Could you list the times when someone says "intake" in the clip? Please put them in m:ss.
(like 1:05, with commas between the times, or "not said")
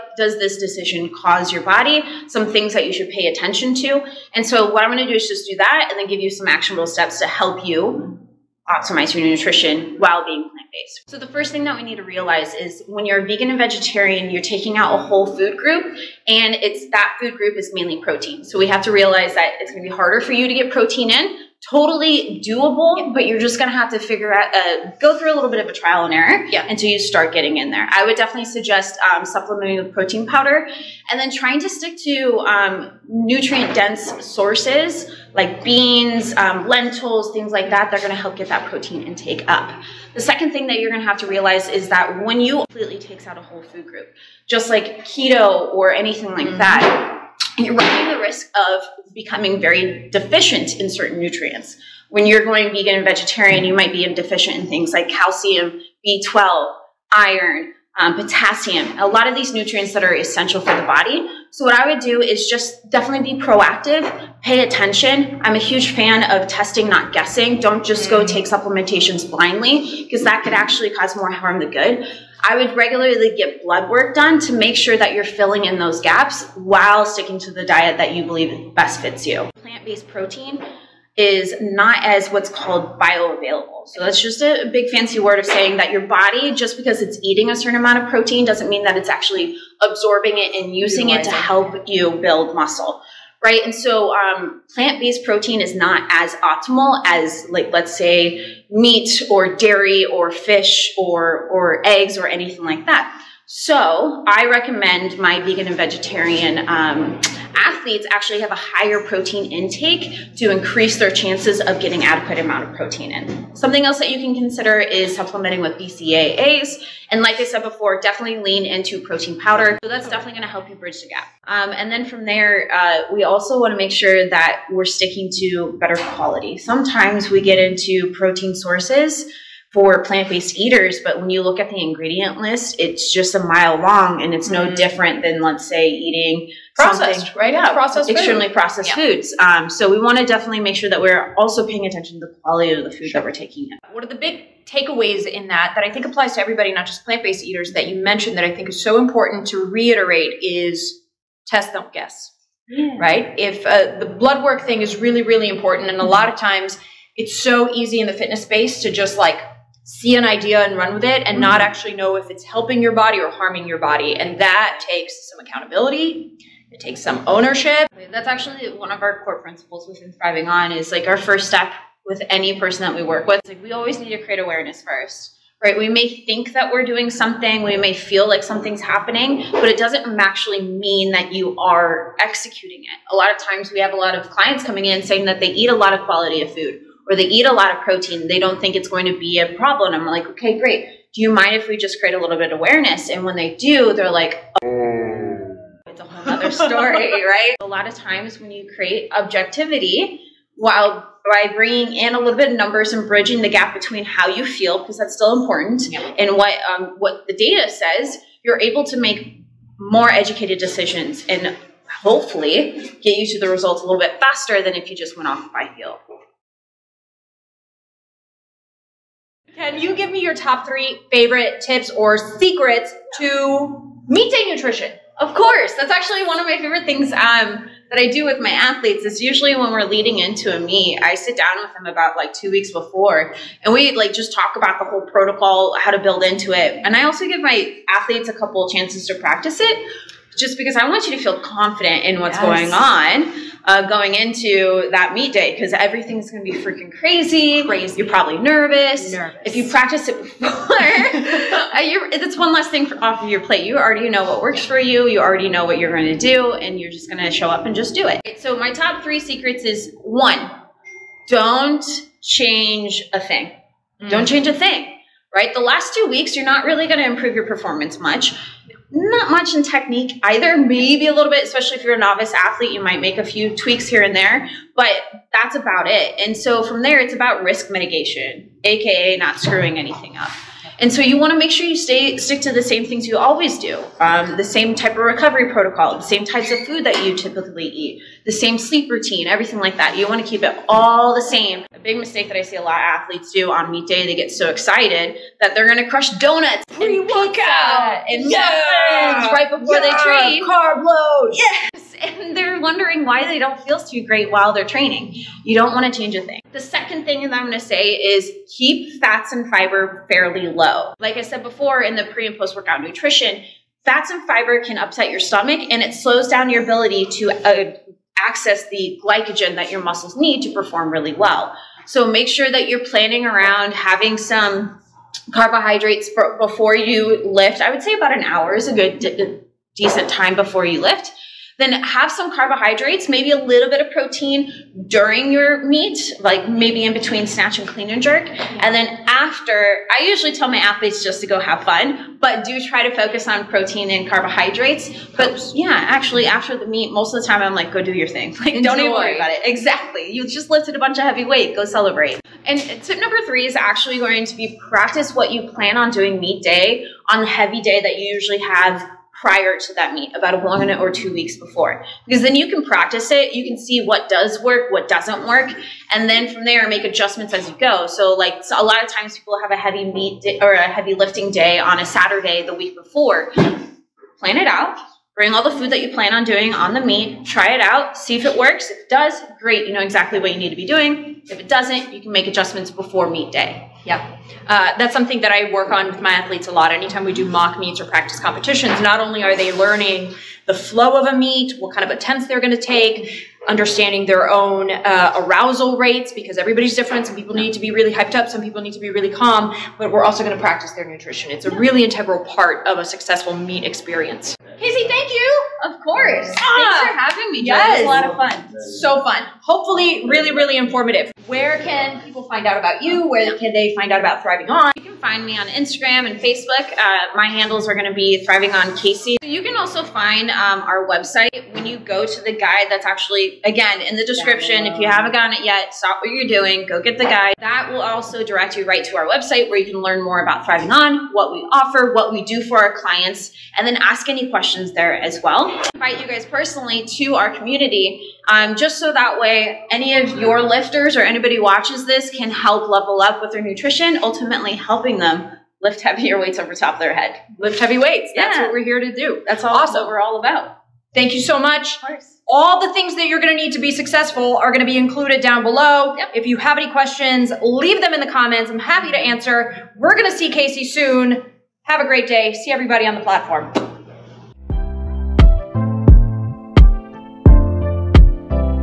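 0:39, 1:49.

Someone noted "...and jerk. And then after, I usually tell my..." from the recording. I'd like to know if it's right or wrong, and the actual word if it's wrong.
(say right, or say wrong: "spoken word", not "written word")
right.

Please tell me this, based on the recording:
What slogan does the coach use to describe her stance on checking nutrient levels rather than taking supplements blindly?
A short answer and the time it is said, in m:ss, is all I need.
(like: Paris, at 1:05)
Testing, not guessing, at 1:06.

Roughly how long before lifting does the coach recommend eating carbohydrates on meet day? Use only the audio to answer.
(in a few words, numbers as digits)
About an hour.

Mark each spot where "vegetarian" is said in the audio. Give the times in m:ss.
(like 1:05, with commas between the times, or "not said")
0:13, 0:53, 1:45.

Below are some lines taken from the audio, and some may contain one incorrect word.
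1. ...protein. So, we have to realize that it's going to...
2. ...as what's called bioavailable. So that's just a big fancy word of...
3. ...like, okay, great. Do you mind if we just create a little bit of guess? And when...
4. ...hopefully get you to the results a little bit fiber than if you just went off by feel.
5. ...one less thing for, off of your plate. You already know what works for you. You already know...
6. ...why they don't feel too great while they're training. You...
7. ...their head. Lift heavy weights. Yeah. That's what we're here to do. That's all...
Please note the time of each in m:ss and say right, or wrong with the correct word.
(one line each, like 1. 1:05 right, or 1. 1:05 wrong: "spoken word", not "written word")
1. 0:18 right
2. 1:22 right
3. 3:10 wrong: "awareness", not "guess"
4. 3:32 wrong: "faster", not "fiber"
5. 4:12 right
6. 5:03 right
7. 7:26 right.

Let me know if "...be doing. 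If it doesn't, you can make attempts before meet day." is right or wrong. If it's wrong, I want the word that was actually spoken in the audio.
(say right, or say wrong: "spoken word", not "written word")
wrong: "adjustments", not "attempts".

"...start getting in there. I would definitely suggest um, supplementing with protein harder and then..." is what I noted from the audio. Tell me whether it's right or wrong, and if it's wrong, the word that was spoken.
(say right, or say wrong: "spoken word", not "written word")
wrong: "powder", not "harder".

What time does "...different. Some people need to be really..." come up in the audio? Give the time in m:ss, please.
6:36.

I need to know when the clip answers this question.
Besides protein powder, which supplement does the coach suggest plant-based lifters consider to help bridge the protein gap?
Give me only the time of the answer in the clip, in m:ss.
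1:55.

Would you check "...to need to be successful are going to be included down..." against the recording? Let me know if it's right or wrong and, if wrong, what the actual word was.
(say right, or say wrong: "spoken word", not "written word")
right.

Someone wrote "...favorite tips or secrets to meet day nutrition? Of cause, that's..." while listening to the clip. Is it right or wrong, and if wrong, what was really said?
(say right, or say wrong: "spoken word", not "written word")
wrong: "course", not "cause".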